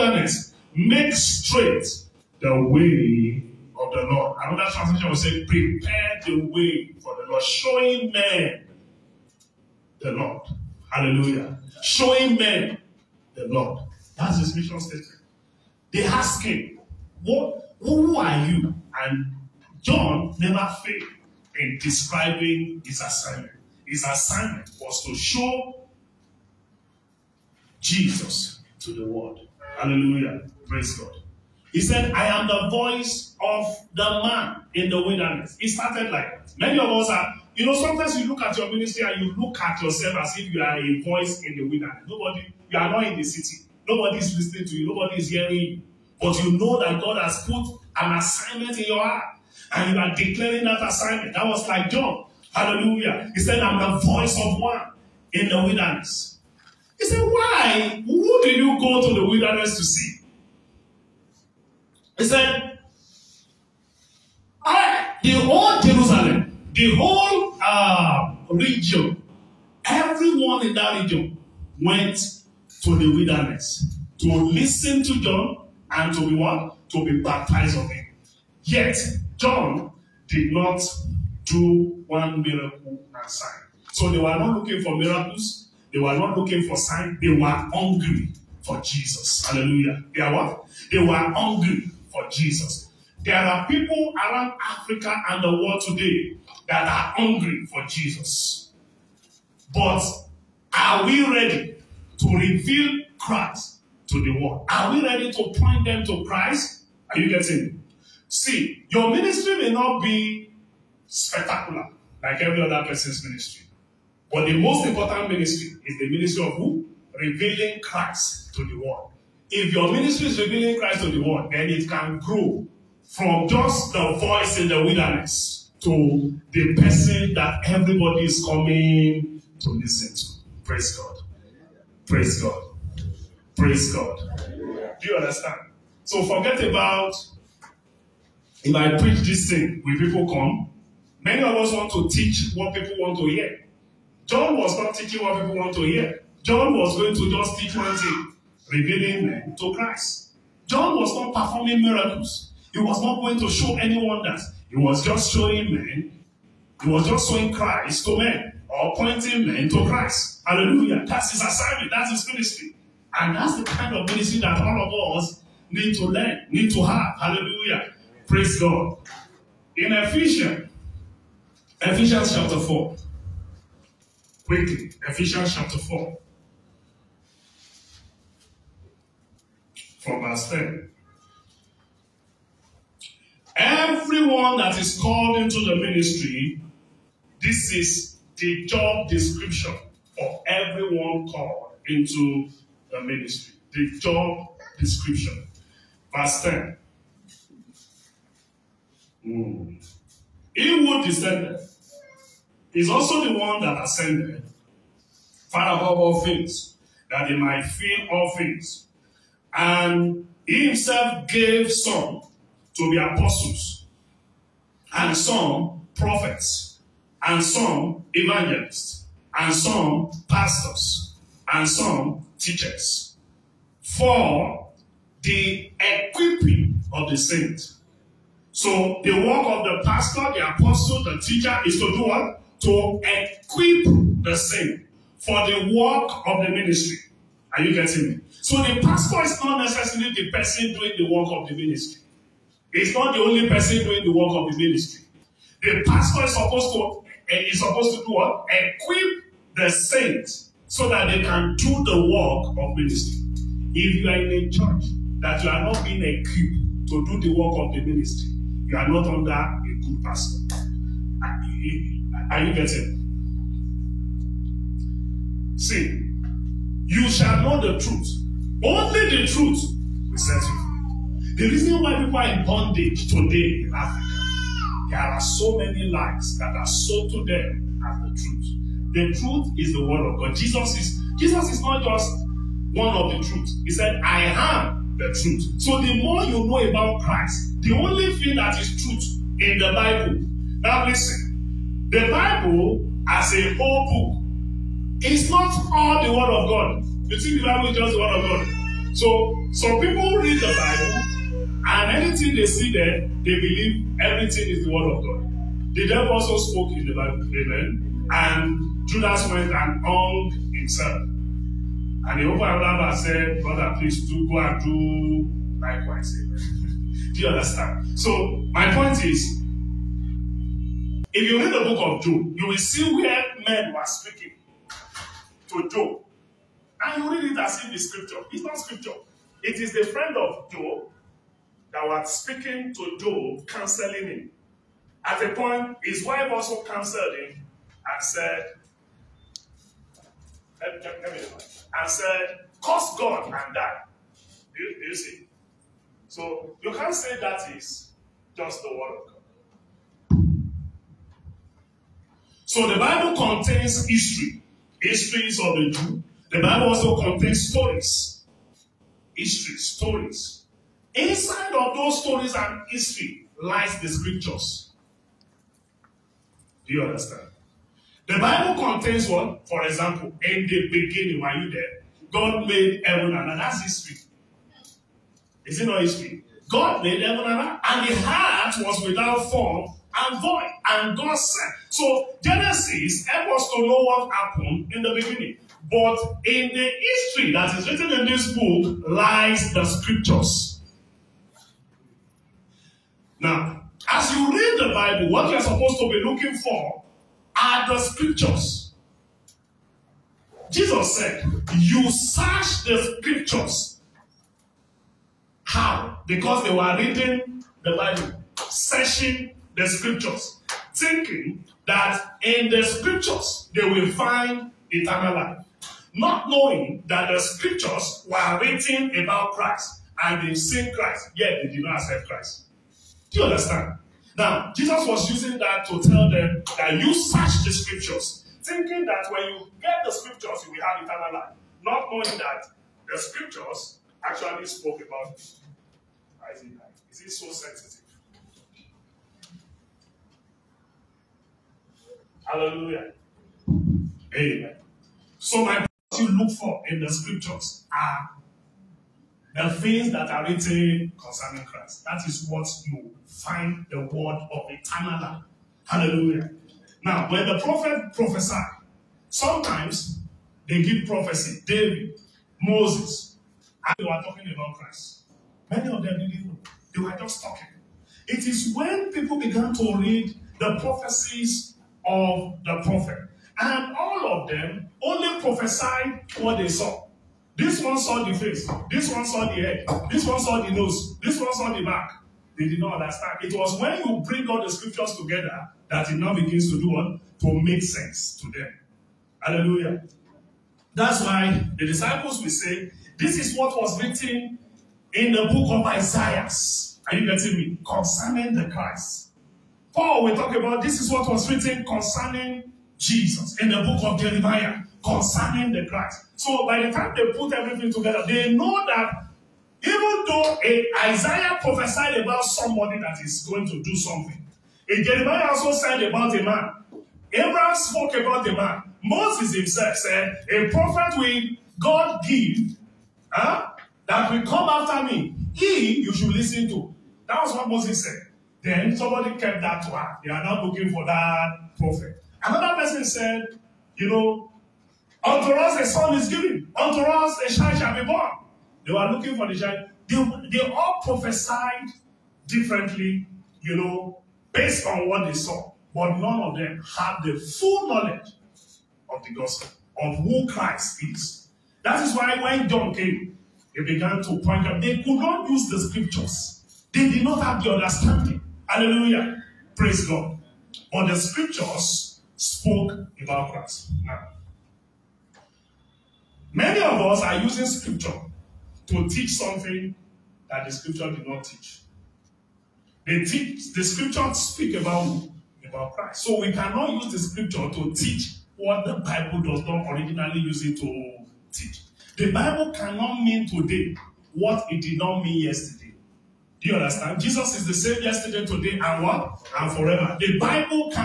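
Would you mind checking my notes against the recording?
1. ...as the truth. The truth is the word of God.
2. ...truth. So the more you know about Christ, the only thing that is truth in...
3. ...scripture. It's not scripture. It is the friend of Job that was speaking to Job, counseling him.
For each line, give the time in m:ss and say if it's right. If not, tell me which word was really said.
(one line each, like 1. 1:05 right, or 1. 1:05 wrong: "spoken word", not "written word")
1. 4:37 right
2. 4:45 right
3. 5:27 right.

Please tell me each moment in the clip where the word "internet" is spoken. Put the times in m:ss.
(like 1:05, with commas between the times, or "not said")
not said.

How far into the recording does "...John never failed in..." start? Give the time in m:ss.
0:19.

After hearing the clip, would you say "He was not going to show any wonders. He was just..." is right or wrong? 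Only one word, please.
right.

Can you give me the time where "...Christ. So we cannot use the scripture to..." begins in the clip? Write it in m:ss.
9:35.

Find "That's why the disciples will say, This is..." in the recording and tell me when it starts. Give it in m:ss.
8:10.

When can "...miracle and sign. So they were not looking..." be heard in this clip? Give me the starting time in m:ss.
1:22.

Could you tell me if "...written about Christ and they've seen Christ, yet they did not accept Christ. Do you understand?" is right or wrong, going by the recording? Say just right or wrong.
right.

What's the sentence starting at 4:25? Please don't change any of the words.
See, you shall know the truth, Only the truth will set you free.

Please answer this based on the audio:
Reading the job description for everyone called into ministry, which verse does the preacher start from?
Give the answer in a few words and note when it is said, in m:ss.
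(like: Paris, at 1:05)
10, at 2:59.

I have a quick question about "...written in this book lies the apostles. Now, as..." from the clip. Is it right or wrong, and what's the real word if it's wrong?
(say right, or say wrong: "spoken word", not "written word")
wrong: "scriptures", not "apostles".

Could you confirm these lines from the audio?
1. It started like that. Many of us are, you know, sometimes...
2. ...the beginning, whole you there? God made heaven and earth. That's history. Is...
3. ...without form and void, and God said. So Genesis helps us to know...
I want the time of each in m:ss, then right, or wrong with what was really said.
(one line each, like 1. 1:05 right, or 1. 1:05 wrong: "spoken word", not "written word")
1. 0:35 right
2. 6:10 wrong: "while", not "whole"
3. 6:18 right.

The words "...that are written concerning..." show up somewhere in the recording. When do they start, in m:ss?
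7:29.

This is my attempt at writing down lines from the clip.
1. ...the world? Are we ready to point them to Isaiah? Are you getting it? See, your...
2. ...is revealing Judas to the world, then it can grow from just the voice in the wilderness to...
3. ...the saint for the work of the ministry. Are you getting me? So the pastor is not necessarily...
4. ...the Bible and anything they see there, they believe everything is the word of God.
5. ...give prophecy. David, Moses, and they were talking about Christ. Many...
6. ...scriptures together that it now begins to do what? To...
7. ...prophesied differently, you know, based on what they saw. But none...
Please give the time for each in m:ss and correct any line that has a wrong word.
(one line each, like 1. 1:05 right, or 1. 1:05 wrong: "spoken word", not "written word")
1. 1:44 wrong: "Christ", not "Isaiah"
2. 2:00 wrong: "Christ", not "Judas"
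3. 3:54 right
4. 5:00 right
5. 7:40 right
6. 8:04 right
7. 9:00 right.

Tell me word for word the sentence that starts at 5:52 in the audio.
So the Bible contains history, histories of the Jew, The Bible also contains stories, history, stories.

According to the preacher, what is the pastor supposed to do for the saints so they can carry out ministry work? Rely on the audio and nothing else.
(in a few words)
Equip the saints.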